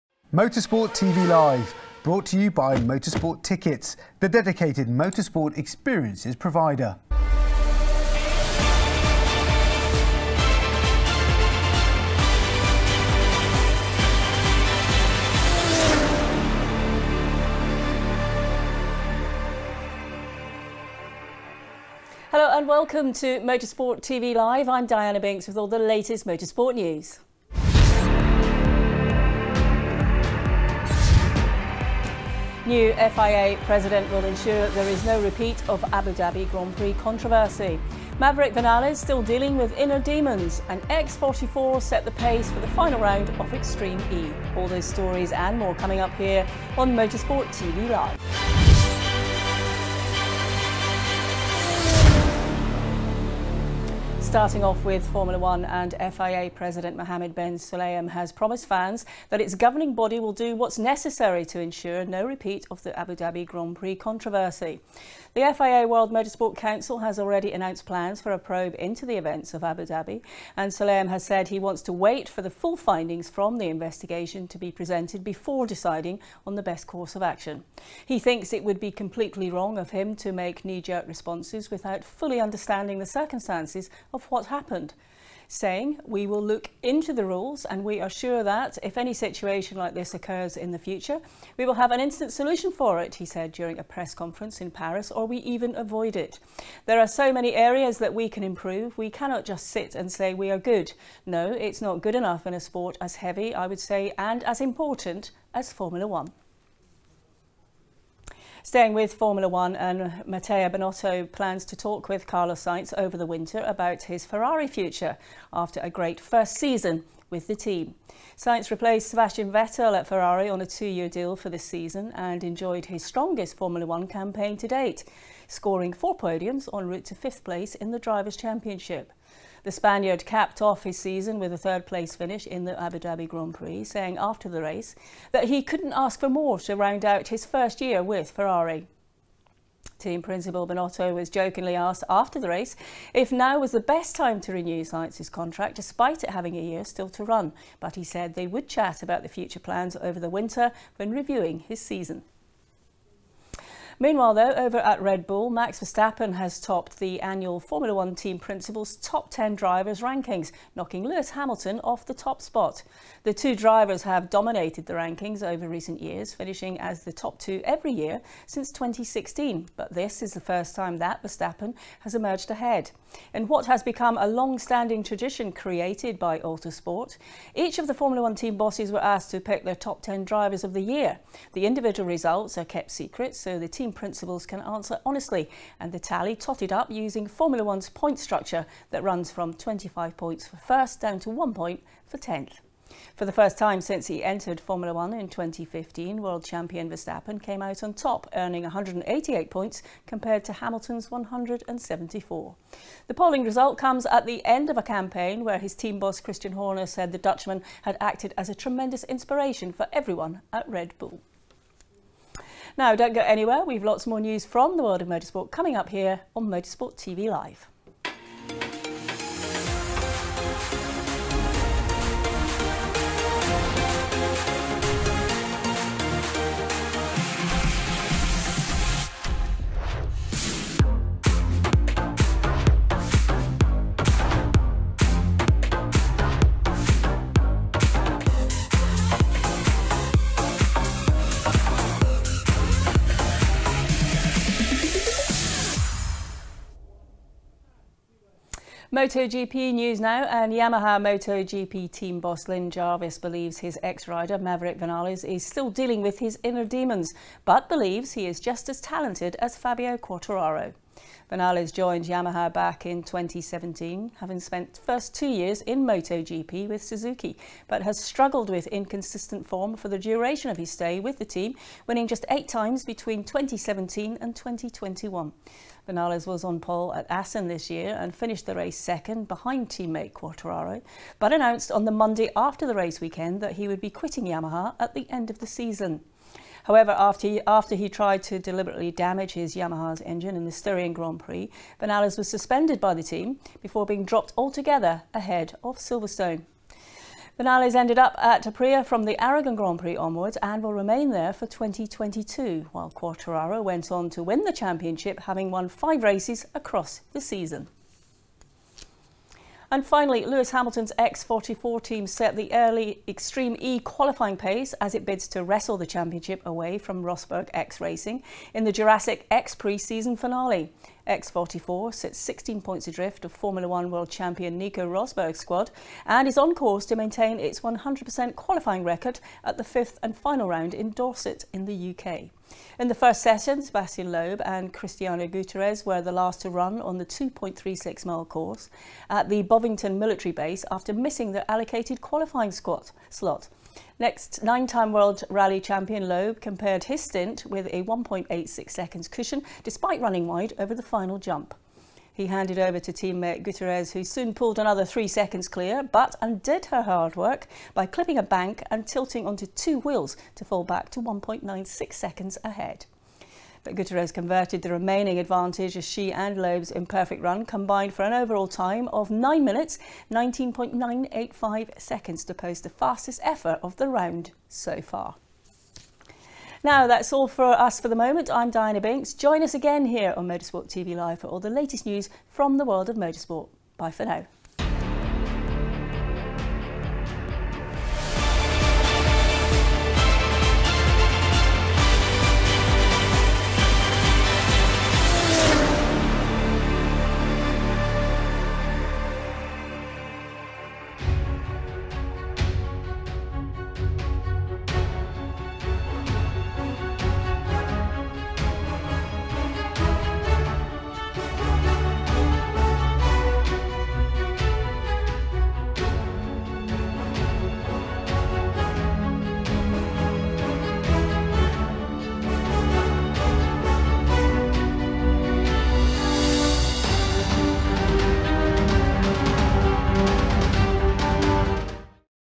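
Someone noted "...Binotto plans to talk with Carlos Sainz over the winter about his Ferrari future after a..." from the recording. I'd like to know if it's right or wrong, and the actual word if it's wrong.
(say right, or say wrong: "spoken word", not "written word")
right.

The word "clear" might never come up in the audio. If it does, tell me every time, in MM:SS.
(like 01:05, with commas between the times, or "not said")
05:55.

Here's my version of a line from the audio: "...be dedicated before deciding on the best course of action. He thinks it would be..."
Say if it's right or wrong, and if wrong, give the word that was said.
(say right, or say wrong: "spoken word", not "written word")
wrong: "presented", not "dedicated".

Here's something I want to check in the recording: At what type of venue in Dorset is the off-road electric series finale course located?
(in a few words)
military base.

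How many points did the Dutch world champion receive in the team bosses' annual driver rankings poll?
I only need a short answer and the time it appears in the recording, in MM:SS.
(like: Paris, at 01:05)
188, at 03:18.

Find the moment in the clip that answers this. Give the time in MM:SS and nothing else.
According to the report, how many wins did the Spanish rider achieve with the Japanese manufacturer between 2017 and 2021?
04:32.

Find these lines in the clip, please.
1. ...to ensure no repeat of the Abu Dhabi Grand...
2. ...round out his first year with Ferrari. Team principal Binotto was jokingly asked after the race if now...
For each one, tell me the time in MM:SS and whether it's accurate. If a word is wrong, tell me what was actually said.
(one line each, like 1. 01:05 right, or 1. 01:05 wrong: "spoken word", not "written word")
1. 01:01 right
2. 02:16 right.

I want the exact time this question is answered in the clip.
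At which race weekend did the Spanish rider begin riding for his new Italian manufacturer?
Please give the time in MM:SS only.
04:59.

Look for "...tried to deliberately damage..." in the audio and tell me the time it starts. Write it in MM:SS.
04:47.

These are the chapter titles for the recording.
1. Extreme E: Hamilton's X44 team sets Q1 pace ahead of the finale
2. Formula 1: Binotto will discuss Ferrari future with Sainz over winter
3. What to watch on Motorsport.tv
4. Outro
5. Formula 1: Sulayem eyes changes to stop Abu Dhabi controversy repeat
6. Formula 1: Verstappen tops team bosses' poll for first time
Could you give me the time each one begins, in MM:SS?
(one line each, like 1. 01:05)
1. 05:10
2. 01:48
3. 03:33
4. 06:07
5. 00:55
6. 02:34.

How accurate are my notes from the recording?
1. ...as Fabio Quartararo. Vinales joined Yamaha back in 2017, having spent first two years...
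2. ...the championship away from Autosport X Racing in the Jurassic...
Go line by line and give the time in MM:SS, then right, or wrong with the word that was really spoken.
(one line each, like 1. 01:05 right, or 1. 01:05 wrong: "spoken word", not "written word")
1. 04:19 right
2. 05:15 wrong: "Rosberg", not "Autosport".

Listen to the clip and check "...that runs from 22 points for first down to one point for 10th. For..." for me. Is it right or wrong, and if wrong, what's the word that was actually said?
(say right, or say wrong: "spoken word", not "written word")
wrong: "25", not "22".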